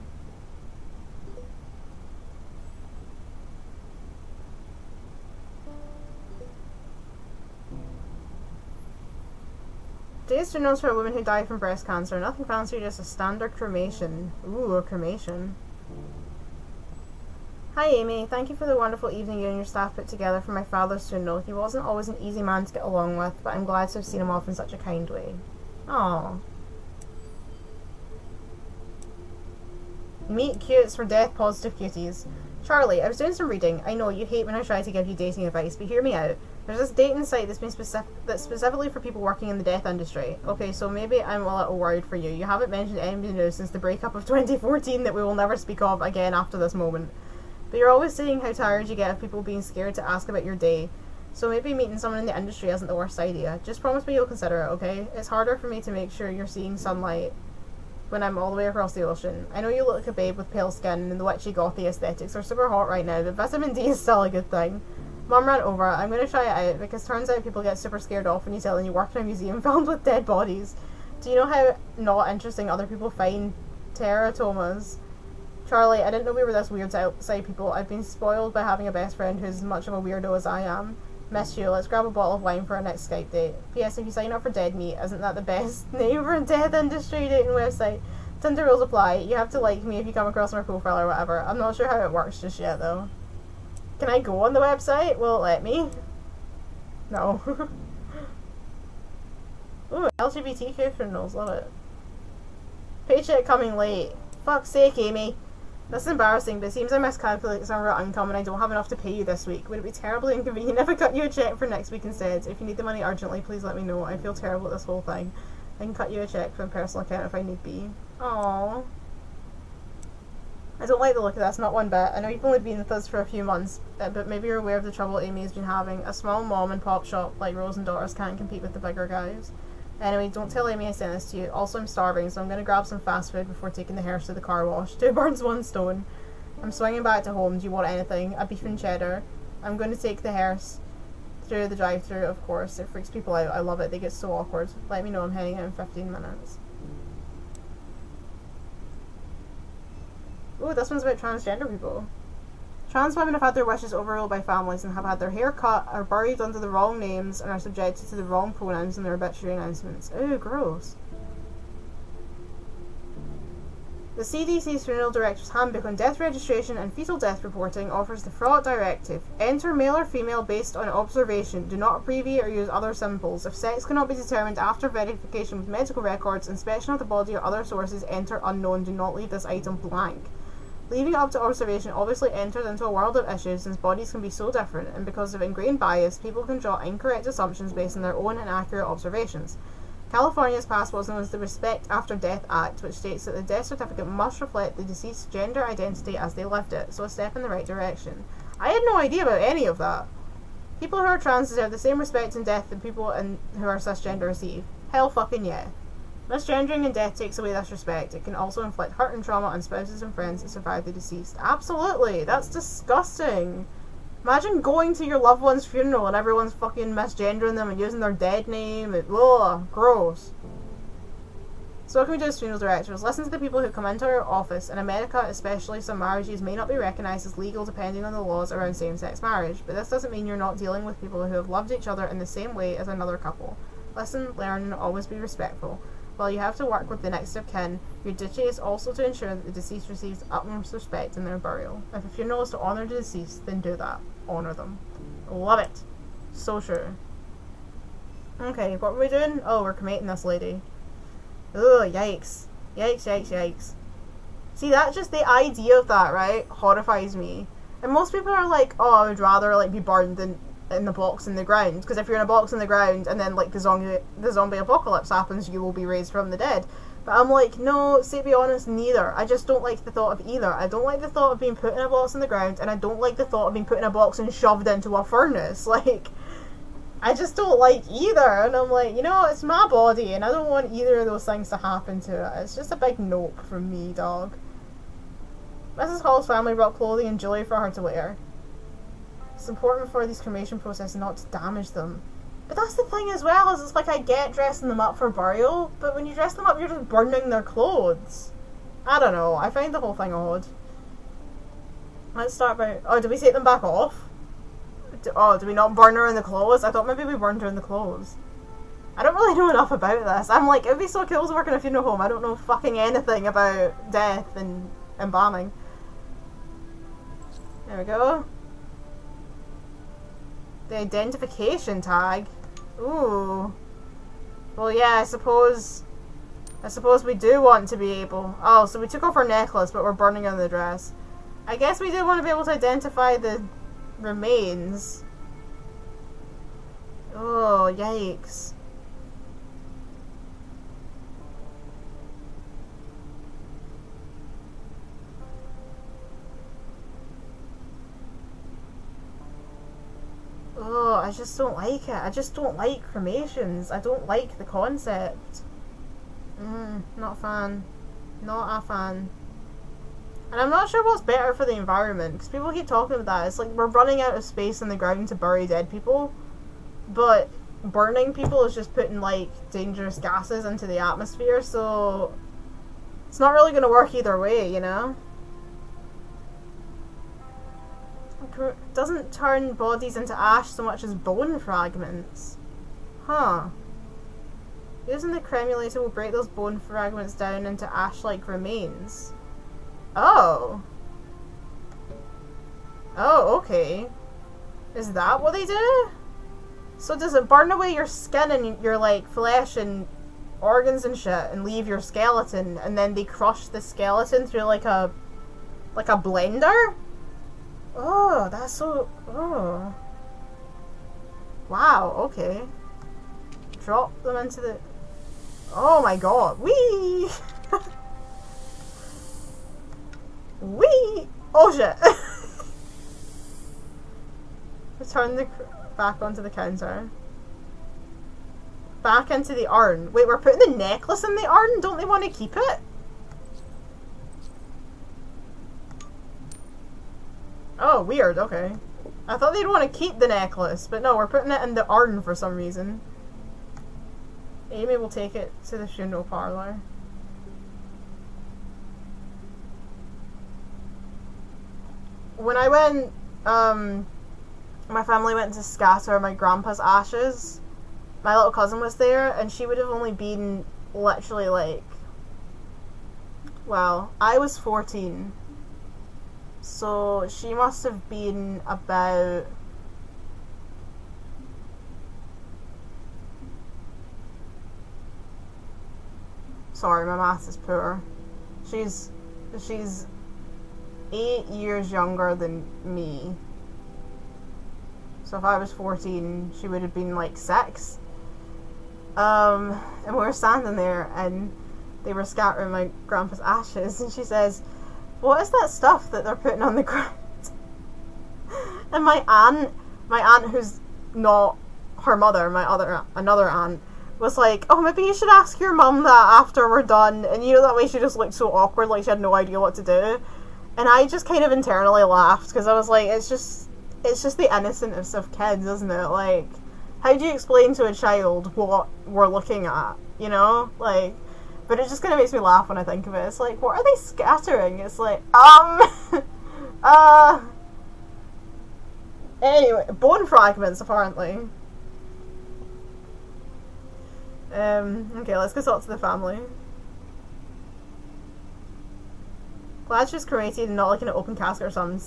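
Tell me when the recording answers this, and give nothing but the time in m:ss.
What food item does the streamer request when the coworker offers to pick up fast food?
2:18.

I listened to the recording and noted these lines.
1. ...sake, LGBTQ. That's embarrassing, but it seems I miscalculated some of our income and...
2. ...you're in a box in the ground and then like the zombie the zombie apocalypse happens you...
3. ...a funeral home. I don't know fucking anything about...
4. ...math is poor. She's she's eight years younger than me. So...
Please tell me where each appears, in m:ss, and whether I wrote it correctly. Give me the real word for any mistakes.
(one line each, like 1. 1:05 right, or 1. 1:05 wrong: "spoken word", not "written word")
1. 1:44 wrong: "Amy", not "LGBTQ"
2. 4:22 right
3. 5:11 right
4. 7:56 right.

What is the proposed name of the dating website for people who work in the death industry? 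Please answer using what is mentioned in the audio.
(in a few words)
Dead Meat.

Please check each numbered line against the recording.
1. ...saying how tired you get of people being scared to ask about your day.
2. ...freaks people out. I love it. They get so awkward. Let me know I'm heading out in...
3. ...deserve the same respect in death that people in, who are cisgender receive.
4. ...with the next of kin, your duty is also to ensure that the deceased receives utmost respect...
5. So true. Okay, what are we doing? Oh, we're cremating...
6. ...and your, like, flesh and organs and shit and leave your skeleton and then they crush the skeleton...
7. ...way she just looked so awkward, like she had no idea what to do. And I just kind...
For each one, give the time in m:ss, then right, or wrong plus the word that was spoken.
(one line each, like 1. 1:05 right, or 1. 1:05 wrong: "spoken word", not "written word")
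1. 0:48 right
2. 2:22 right
3. 3:21 right
4. 3:56 right
5. 4:06 right
6. 6:38 right
7. 8:27 right.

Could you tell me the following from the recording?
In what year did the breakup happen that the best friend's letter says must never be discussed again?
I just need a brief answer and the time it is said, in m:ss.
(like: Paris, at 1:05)
2014, at 0:44.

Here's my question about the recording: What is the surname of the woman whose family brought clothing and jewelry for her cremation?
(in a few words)
Hall.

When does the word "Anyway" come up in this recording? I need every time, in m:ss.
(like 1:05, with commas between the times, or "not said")
2:09, 8:49.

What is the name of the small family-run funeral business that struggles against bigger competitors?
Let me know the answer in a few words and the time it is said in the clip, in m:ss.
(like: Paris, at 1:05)
Rose and Daughters, at 2:07.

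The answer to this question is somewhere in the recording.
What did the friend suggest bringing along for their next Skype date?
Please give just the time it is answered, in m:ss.
1:22.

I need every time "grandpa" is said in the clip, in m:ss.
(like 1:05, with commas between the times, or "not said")
7:36, 8:12.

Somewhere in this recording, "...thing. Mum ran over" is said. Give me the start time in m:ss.
1:04.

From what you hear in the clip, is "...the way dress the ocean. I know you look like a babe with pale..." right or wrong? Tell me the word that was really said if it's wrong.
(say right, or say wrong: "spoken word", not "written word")
wrong: "across", not "dress".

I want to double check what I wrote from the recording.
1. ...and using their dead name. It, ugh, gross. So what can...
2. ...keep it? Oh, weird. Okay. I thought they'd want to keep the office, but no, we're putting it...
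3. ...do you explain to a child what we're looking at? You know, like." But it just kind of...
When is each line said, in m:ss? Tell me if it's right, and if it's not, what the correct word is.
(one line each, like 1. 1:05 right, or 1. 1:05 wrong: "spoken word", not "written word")
1. 3:37 right
2. 7:12 wrong: "necklace", not "office"
3. 8:36 right.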